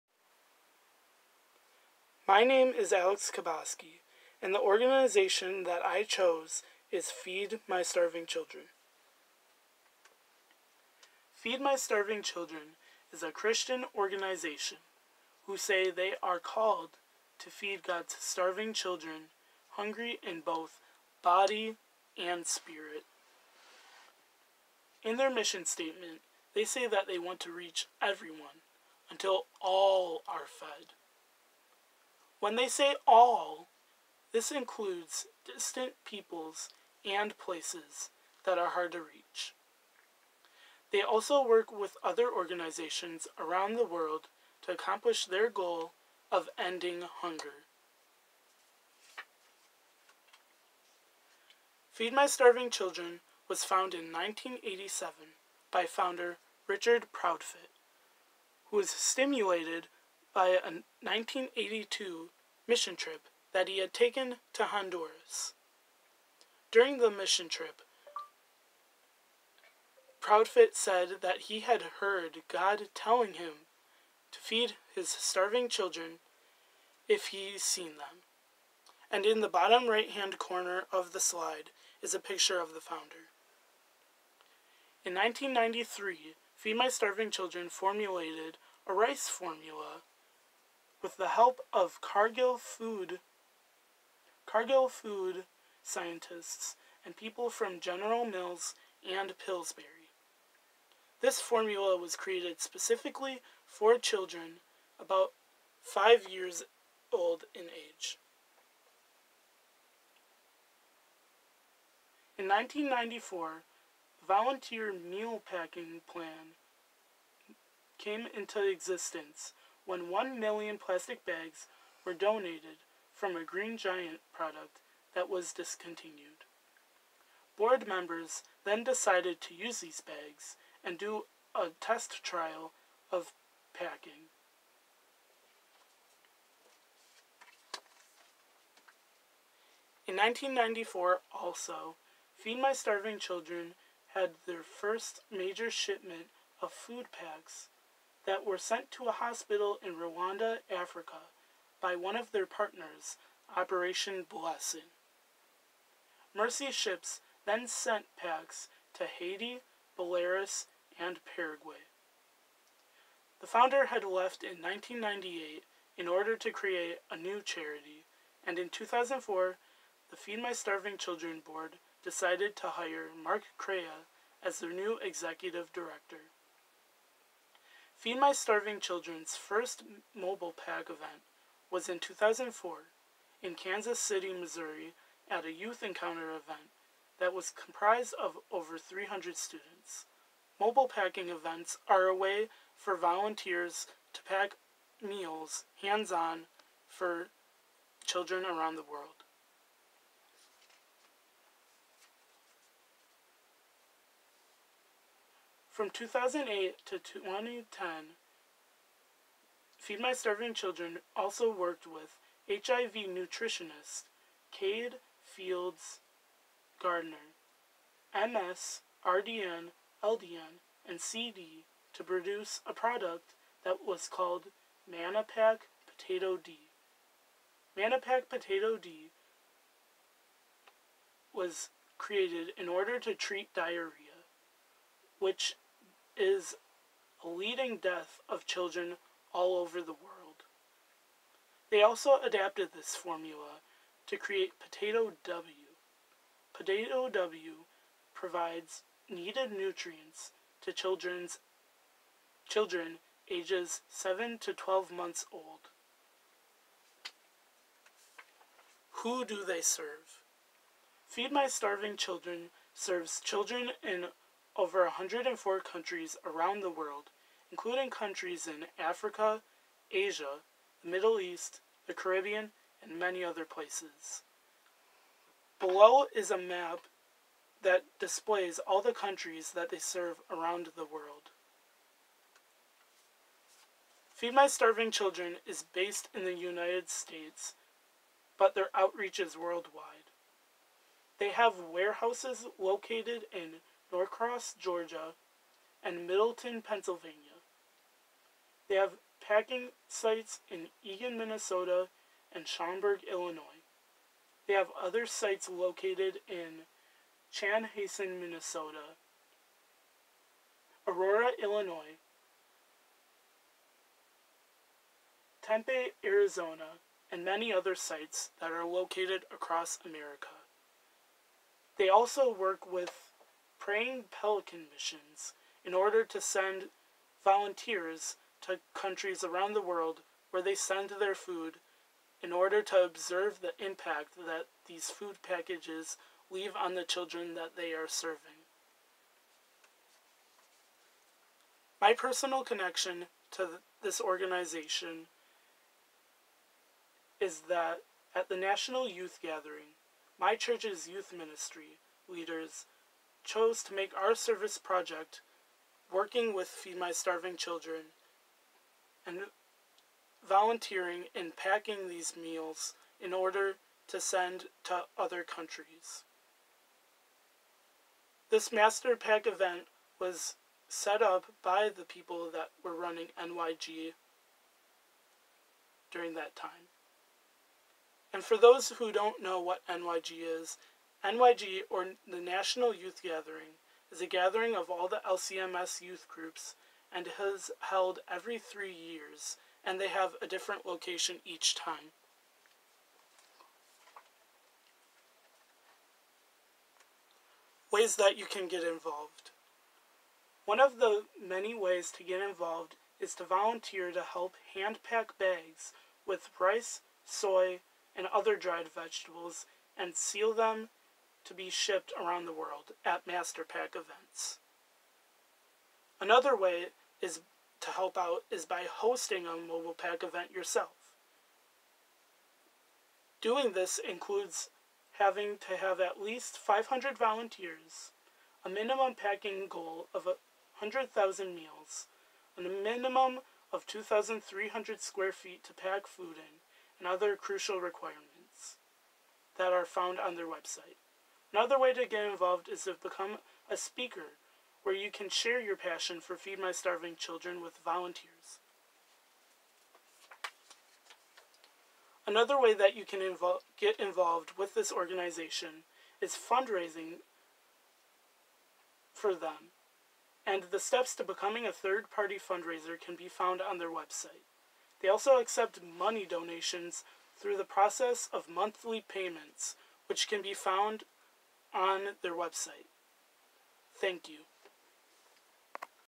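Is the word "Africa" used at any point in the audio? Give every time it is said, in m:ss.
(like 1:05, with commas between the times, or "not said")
2:30, 4:28.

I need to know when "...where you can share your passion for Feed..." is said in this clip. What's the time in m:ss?
7:24.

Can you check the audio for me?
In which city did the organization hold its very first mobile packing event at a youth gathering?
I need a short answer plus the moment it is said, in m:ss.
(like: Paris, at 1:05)
Kansas City, at 3:03.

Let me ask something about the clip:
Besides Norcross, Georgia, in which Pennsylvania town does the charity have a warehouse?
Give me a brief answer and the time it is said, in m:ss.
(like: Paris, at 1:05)
Middletown, at 4:56.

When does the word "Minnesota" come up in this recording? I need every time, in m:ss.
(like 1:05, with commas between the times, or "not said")
5:01, 5:08.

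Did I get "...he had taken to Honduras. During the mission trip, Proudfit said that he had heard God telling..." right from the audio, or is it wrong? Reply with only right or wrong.
right.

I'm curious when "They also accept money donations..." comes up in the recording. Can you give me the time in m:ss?
7:44.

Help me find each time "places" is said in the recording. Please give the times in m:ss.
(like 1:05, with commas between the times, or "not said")
0:37, 4:33.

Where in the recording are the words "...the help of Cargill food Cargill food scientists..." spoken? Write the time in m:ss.
1:31.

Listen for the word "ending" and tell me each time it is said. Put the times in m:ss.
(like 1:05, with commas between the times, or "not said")
0:46.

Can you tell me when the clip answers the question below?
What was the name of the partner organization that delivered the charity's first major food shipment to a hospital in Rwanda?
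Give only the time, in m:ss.
2:33.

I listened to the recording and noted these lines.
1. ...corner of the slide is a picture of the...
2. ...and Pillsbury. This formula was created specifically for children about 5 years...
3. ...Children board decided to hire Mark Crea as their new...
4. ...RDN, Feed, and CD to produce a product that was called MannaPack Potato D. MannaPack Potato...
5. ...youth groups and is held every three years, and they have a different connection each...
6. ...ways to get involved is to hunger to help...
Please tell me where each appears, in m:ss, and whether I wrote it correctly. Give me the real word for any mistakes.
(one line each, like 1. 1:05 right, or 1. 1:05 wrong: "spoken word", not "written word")
1. 1:20 right
2. 1:39 right
3. 2:50 right
4. 3:39 wrong: "LDN", not "Feed"
5. 6:25 wrong: "location", not "connection"
6. 6:41 wrong: "volunteer", not "hunger".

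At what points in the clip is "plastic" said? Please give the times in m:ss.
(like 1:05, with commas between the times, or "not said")
2:00.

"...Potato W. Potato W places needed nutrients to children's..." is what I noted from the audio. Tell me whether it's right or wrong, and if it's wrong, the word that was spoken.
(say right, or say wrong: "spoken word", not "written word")
wrong: "provides", not "places".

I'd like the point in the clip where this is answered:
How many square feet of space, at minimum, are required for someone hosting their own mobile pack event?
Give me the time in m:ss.
7:13.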